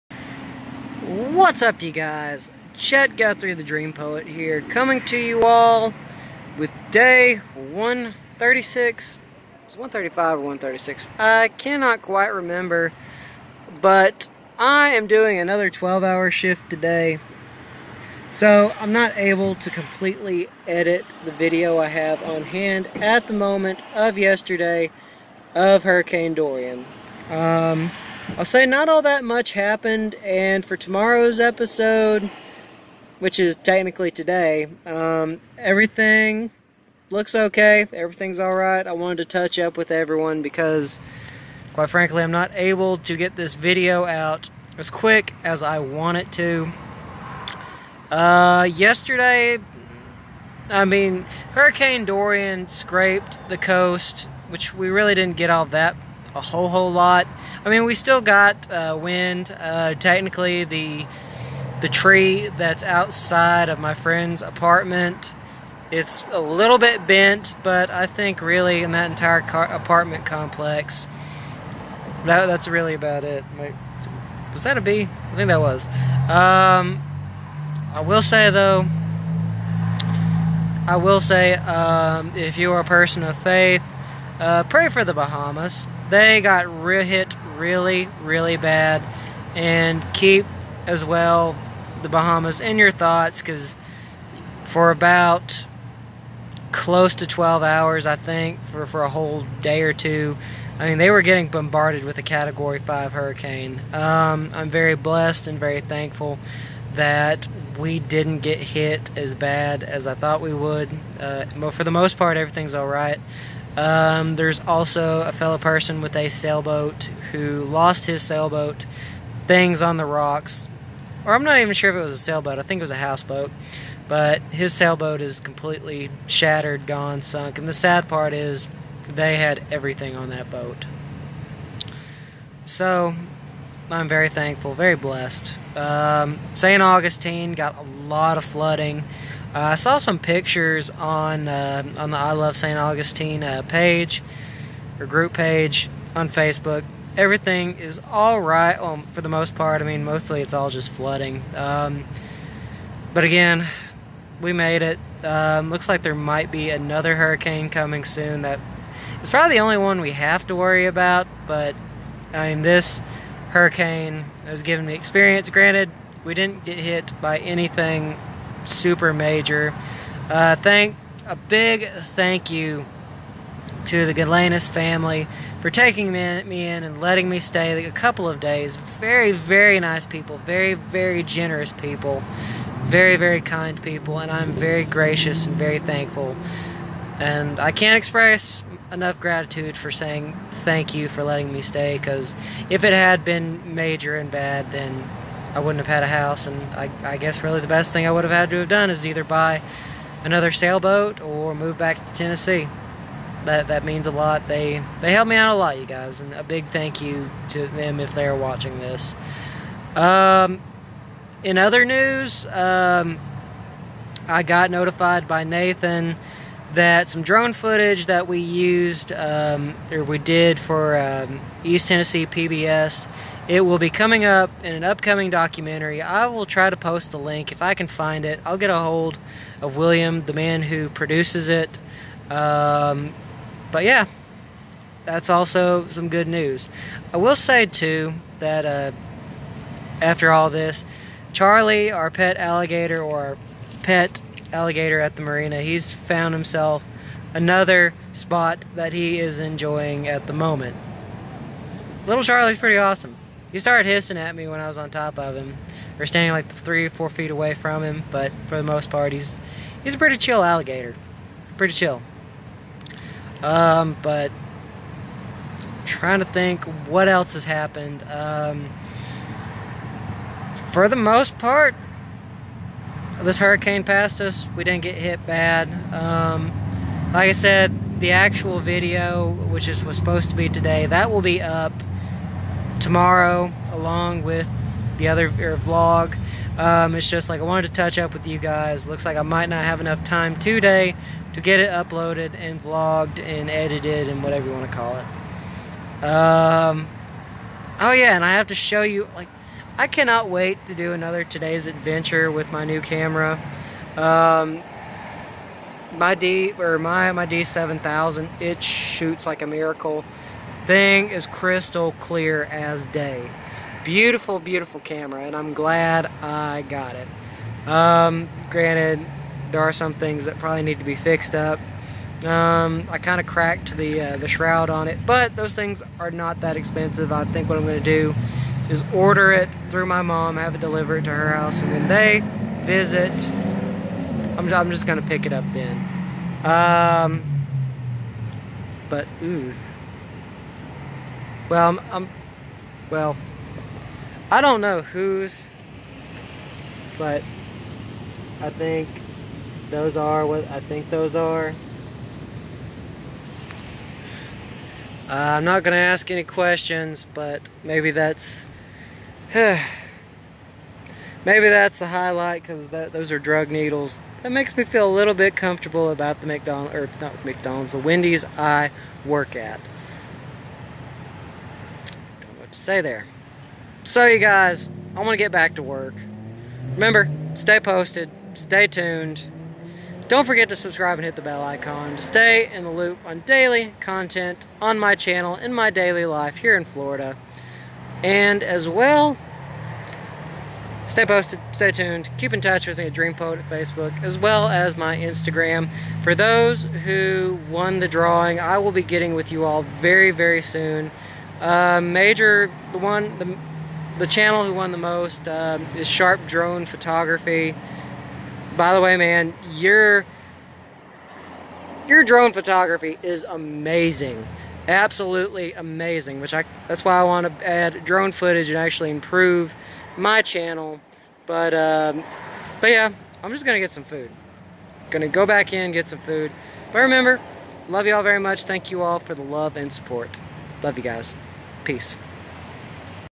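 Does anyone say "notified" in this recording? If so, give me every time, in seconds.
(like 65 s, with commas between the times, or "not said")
214 s.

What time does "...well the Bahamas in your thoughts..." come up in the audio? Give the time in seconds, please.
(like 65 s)
91 s.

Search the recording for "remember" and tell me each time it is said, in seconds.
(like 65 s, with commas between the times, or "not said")
12 s, 376 s, 426 s.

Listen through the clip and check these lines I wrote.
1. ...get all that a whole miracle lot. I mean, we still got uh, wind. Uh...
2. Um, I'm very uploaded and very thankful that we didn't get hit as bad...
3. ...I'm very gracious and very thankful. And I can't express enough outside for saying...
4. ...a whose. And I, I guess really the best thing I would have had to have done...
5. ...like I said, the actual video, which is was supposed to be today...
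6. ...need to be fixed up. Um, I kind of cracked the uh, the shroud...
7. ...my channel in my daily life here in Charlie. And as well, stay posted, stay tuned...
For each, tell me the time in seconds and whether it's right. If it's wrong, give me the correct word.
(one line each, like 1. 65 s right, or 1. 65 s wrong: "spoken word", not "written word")
1. 55 s wrong: "whole", not "miracle"
2. 103 s wrong: "blessed", not "uploaded"
3. 184 s wrong: "gratitude", not "outside"
4. 196 s wrong: "house", not "whose"
5. 277 s right
6. 320 s right
7. 384 s wrong: "Florida", not "Charlie".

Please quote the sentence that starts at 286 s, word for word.
Um, it's just like I wanted to touch up with you guys.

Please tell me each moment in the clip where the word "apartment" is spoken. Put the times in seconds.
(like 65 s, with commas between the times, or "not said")
64 s, 69 s.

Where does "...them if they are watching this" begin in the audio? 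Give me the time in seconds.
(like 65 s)
207 s.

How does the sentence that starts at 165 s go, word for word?
Granted, we didn't get hit by anything super major.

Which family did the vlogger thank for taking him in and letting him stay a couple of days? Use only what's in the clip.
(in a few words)
The Galenas family.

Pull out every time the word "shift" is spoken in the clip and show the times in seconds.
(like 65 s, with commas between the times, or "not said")
16 s.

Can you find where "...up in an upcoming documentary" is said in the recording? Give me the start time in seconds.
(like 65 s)
224 s.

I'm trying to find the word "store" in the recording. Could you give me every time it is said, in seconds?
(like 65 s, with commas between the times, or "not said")
not said.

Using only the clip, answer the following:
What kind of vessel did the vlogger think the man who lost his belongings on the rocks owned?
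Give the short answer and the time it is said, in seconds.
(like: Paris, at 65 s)
Houseboat, at 122 s.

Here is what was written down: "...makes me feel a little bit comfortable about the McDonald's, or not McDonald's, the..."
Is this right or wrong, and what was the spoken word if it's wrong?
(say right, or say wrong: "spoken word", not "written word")
right.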